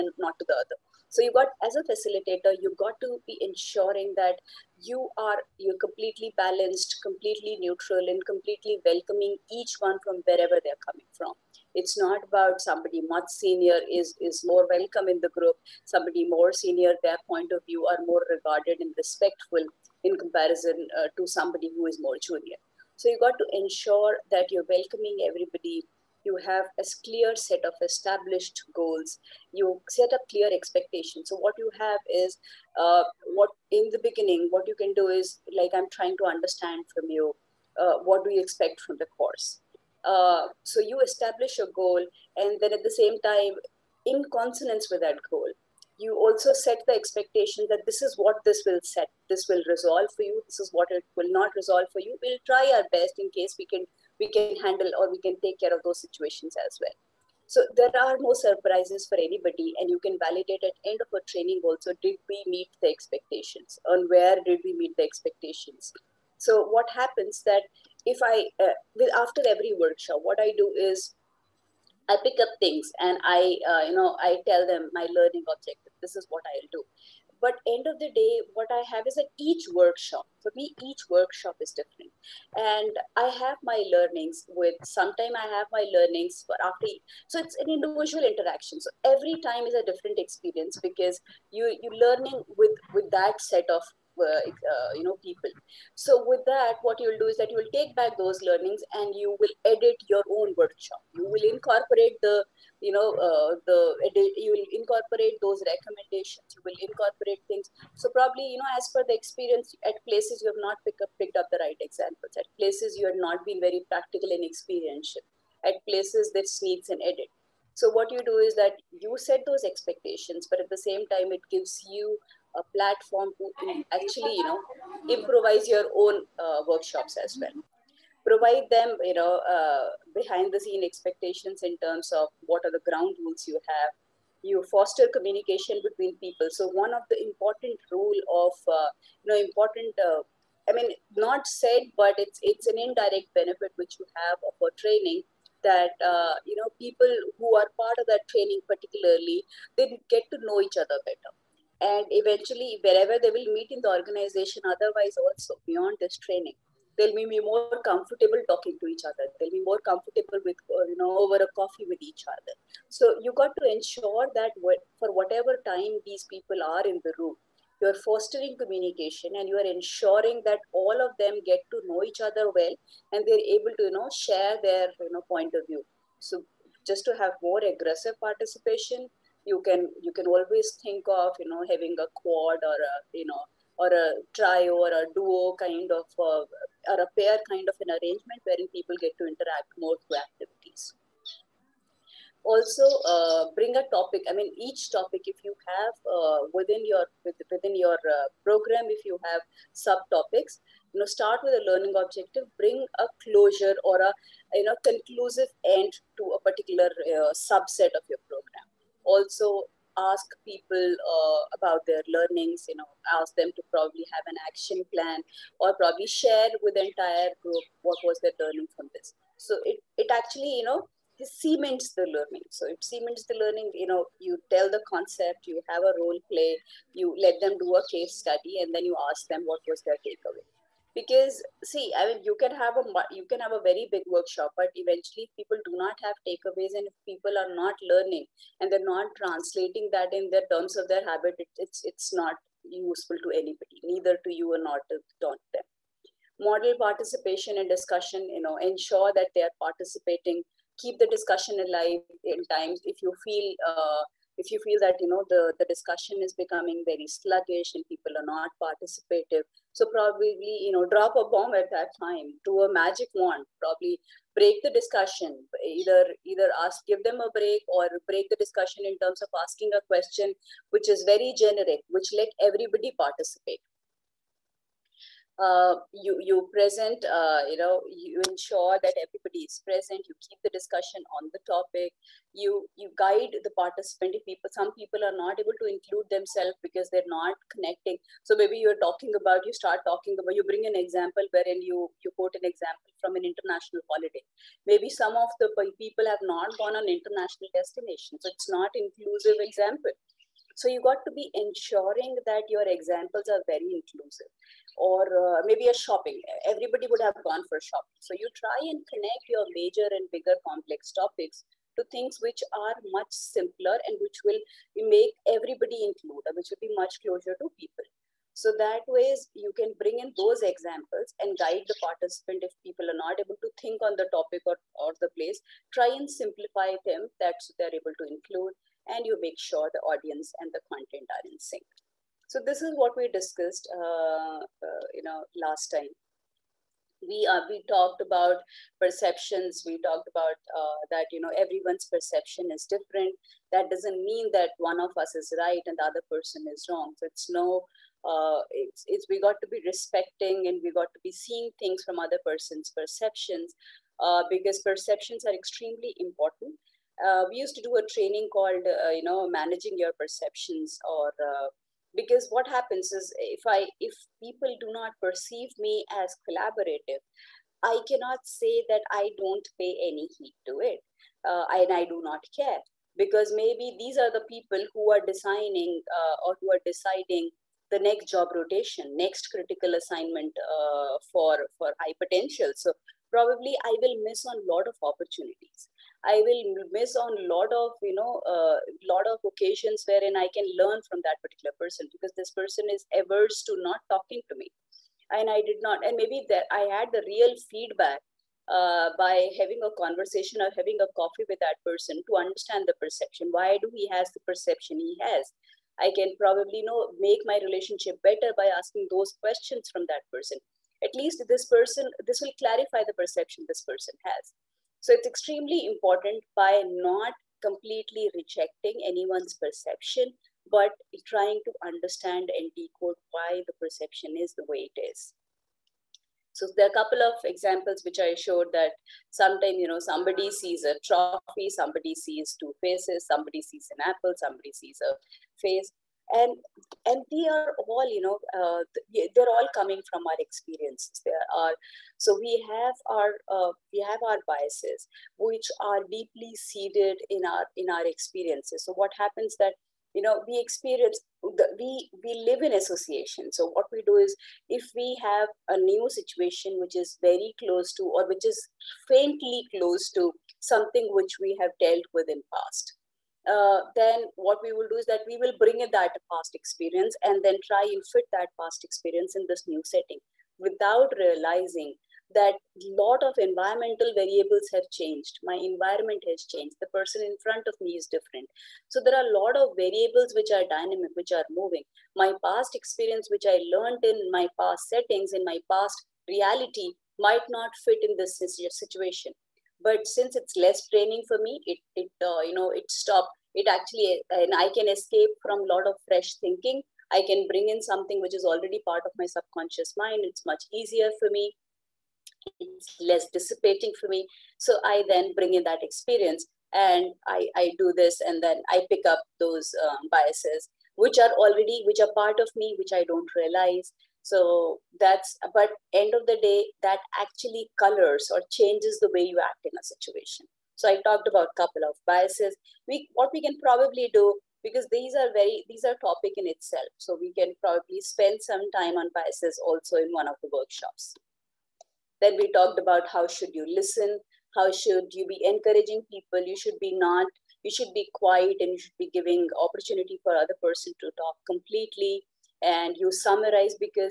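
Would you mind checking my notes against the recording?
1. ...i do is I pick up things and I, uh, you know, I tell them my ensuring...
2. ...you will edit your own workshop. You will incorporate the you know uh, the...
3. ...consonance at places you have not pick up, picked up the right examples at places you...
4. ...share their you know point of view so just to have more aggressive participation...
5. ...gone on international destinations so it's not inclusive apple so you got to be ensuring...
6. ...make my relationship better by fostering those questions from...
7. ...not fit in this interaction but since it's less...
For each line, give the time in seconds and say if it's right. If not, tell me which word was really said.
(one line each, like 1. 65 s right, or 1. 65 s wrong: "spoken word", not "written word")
1. 70 s wrong: "learning", not "ensuring"
2. 99 s right
3. 109 s wrong: "experience", not "consonance"
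4. 174 s right
5. 296 s wrong: "example", not "apple"
6. 406 s wrong: "asking", not "fostering"
7. 487 s wrong: "situation", not "interaction".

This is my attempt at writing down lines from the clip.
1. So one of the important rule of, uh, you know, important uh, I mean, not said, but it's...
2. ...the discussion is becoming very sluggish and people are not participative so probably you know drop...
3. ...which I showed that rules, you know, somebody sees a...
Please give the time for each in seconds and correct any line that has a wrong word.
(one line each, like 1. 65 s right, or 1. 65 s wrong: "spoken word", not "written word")
1. 136 s right
2. 255 s right
3. 427 s wrong: "sometimes", not "rules".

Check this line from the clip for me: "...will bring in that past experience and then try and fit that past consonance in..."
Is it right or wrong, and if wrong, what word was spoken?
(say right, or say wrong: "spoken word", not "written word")
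wrong: "experience", not "consonance".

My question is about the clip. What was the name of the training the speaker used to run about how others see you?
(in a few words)
managing your perceptions.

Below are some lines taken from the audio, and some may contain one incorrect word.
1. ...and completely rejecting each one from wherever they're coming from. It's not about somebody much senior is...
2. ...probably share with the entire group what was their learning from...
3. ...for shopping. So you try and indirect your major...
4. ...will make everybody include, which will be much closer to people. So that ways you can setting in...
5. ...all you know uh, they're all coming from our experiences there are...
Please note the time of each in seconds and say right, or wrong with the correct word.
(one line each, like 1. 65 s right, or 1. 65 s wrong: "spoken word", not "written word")
1. 8 s wrong: "welcoming", not "rejecting"
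2. 215 s right
3. 307 s wrong: "connect", not "indirect"
4. 314 s wrong: "bring", not "setting"
5. 437 s right.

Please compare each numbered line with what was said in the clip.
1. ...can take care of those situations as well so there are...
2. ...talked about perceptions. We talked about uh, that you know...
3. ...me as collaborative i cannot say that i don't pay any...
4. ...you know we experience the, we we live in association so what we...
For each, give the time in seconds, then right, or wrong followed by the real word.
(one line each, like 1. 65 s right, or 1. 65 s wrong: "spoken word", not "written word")
1. 55 s right
2. 337 s right
3. 365 s right
4. 449 s right.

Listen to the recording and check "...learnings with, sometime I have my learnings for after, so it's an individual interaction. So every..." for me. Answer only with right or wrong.
right.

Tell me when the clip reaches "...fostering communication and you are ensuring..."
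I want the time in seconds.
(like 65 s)
168 s.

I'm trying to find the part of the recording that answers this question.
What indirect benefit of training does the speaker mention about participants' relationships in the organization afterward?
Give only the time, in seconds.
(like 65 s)
149 s.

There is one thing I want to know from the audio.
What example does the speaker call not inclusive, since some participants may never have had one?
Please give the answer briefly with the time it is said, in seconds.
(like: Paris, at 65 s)
an international holiday, at 293 s.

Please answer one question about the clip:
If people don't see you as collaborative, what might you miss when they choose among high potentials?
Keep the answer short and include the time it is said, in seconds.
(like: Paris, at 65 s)
next critical assignment, at 379 s.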